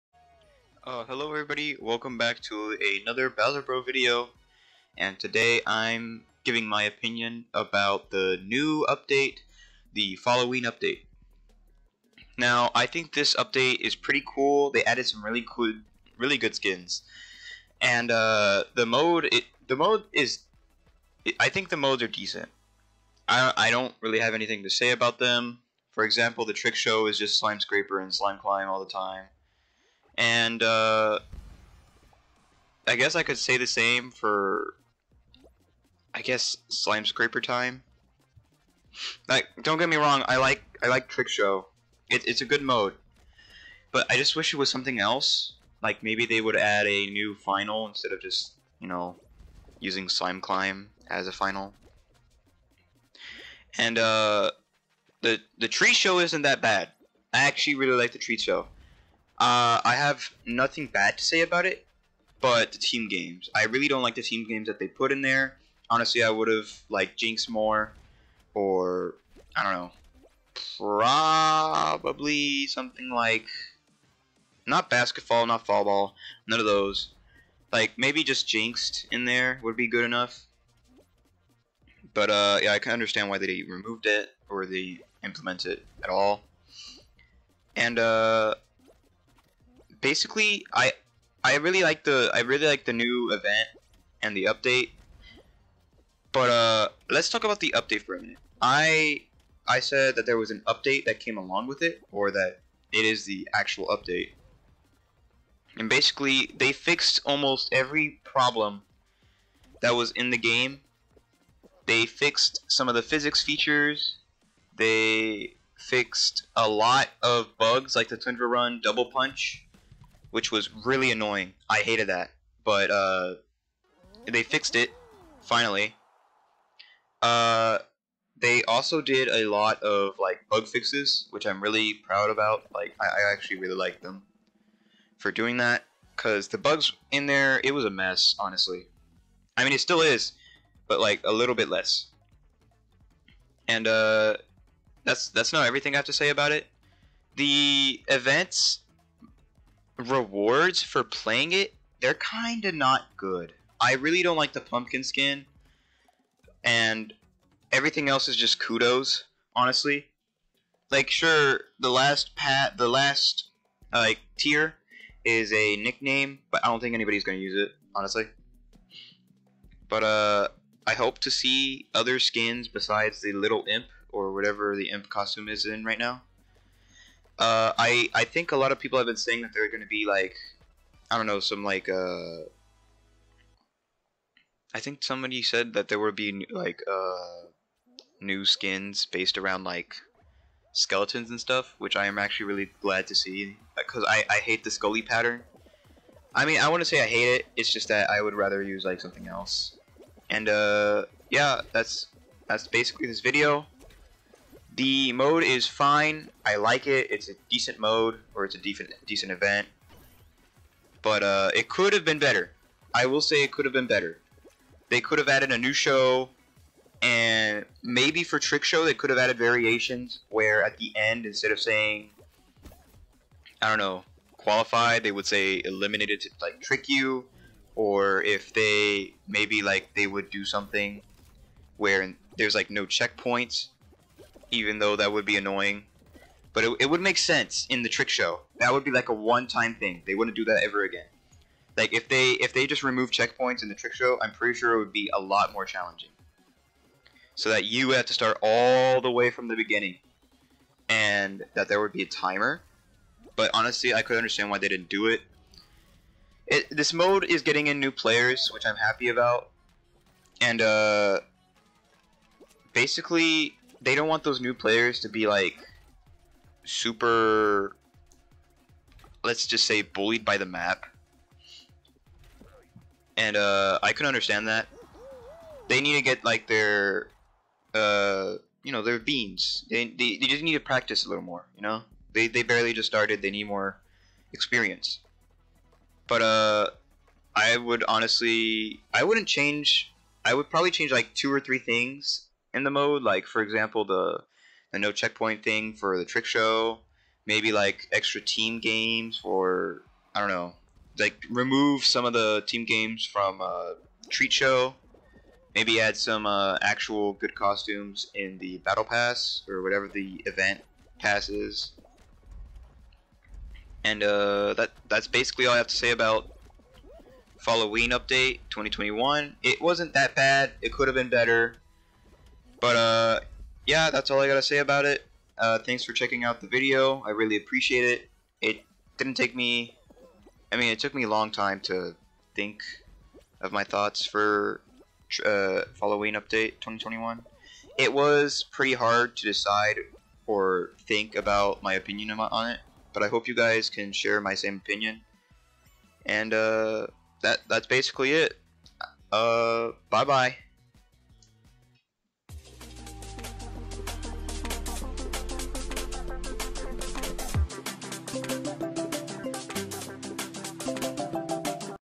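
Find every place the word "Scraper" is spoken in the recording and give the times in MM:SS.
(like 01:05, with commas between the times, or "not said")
00:27, 00:37.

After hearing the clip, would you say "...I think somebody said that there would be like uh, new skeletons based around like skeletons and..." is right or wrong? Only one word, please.
wrong.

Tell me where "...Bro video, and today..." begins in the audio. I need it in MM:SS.
00:03.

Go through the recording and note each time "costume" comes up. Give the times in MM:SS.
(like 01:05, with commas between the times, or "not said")
02:55, 05:07.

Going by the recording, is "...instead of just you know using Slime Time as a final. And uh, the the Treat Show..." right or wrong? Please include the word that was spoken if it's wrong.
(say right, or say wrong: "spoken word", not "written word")
wrong: "Climb", not "Time".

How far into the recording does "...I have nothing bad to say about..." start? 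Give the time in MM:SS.
00:59.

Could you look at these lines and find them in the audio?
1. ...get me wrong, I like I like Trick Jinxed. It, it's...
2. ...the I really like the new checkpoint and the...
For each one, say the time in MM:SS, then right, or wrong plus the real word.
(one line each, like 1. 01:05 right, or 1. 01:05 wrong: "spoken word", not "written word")
1. 00:39 wrong: "Show", not "Jinxed"
2. 01:32 wrong: "event", not "checkpoint".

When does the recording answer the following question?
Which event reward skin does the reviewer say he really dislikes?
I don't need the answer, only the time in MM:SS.
02:34.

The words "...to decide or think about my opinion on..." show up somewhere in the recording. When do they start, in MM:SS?
05:39.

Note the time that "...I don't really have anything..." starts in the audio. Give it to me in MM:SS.
00:23.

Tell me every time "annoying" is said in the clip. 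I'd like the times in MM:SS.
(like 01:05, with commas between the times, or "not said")
02:01, 03:55.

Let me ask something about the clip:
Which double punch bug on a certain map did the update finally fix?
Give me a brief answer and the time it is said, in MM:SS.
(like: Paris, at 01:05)
Tundra Run Double Punch, at 01:58.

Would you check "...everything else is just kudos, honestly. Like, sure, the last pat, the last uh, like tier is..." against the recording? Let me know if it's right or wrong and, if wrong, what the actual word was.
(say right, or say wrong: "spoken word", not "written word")
right.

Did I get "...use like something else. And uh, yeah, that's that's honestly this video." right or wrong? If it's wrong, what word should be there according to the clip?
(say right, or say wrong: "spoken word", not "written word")
wrong: "basically", not "honestly".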